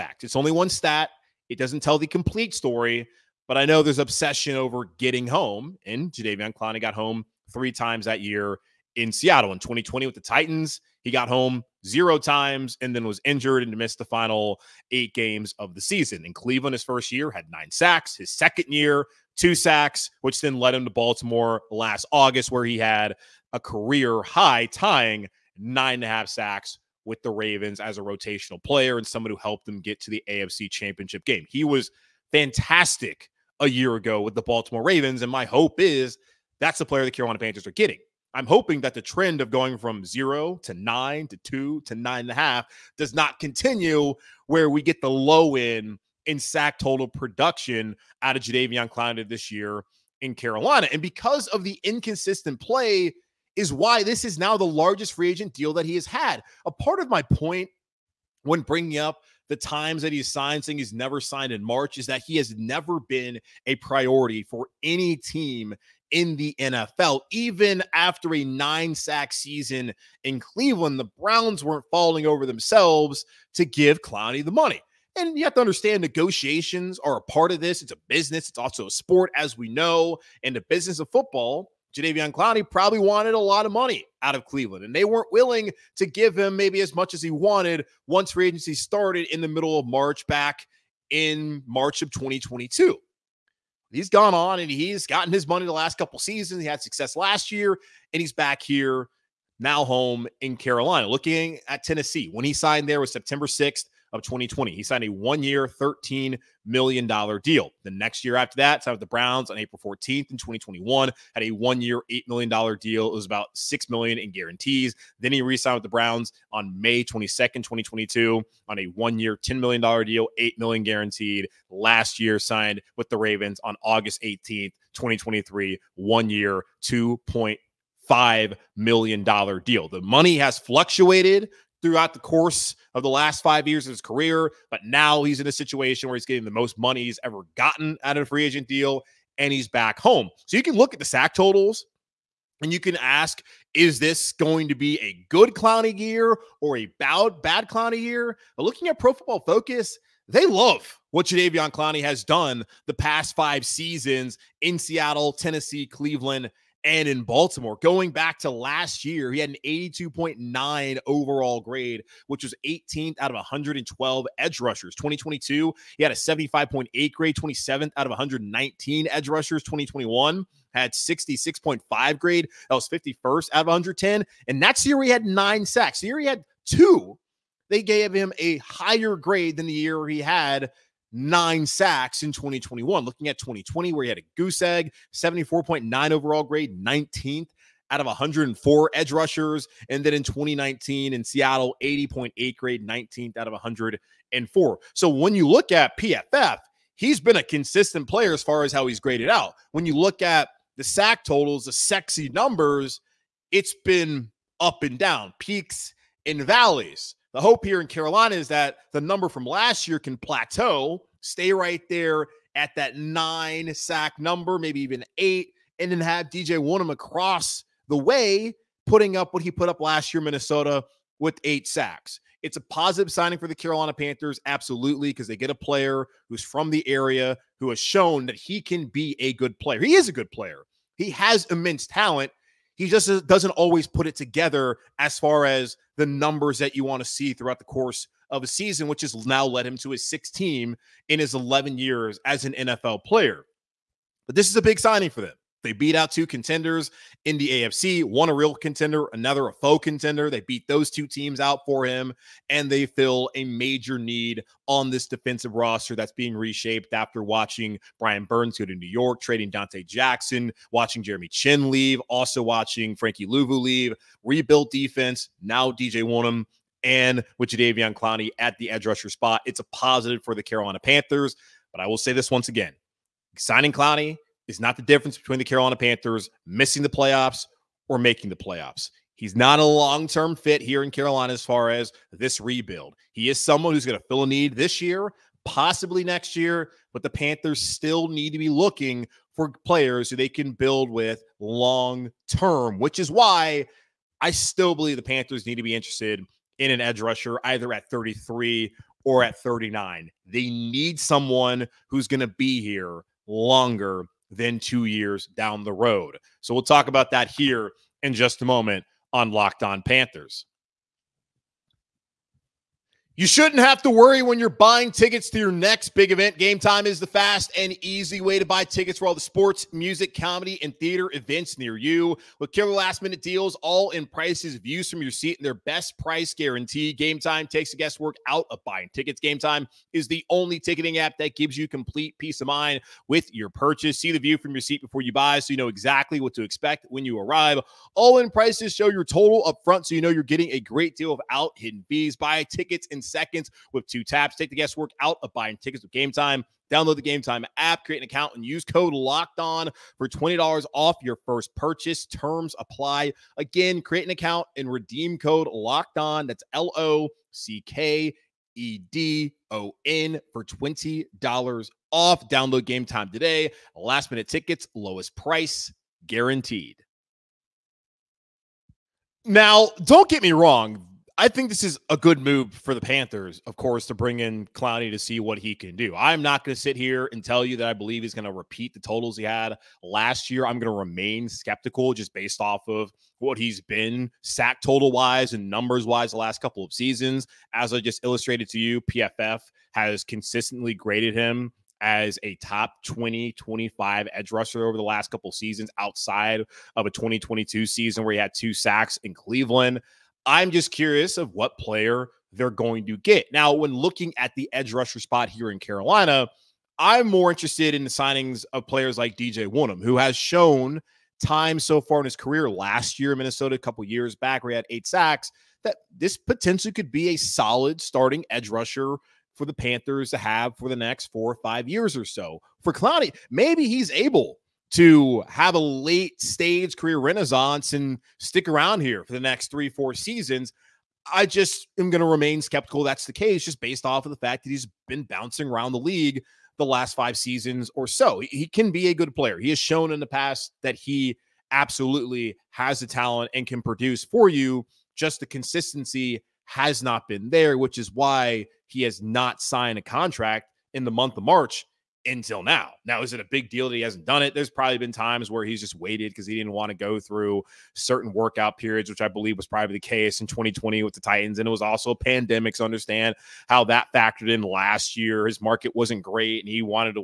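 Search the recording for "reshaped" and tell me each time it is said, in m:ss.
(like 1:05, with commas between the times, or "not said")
4:16.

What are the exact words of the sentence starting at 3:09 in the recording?
And then in 2019 in Seattle, 80.8 grade, 19th out of 104.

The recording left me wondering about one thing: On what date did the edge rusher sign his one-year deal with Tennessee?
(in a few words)
September 6th, 2020.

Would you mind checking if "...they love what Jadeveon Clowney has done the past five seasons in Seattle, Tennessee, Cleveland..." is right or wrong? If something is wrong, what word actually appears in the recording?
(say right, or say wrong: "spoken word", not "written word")
right.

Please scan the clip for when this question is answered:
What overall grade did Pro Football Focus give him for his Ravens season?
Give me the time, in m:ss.
2:39.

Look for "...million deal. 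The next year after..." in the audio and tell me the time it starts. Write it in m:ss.
1:46.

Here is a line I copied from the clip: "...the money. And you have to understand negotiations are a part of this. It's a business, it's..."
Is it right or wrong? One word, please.
right.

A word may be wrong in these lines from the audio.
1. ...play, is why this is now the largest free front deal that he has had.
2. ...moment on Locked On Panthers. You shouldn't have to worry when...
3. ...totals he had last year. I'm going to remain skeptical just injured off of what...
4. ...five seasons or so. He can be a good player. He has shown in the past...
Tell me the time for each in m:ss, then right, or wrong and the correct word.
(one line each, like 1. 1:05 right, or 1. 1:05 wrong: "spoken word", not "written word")
1. 0:52 wrong: "agent", not "front"
2. 5:08 right
3. 6:18 wrong: "based", not "injured"
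4. 7:16 right.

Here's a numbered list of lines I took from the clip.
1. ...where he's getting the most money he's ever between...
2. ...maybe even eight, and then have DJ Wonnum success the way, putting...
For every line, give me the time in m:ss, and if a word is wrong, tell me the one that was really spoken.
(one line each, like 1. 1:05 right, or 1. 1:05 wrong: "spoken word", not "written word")
1. 2:16 wrong: "gotten", not "between"
2. 3:34 wrong: "across", not "success".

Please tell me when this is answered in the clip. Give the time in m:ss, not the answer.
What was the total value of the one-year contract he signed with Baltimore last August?
2:06.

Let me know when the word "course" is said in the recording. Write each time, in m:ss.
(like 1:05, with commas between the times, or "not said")
2:12, 3:57, 6:13.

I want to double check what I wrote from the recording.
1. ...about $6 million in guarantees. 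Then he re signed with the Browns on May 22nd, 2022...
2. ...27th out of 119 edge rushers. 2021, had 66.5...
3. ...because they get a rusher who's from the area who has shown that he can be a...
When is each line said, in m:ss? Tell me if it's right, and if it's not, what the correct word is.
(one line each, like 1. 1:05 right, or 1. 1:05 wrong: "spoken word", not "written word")
1. 1:53 right
2. 2:47 right
3. 3:45 wrong: "player", not "rusher".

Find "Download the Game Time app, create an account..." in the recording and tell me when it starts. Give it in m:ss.
5:46.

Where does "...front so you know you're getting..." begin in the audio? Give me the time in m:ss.
5:39.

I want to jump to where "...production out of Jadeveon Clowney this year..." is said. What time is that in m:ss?
0:47.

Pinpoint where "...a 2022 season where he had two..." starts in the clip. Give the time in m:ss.
6:36.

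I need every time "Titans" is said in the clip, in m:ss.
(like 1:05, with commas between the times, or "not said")
0:10, 7:40.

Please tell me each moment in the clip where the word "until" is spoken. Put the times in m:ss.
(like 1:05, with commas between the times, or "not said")
7:32.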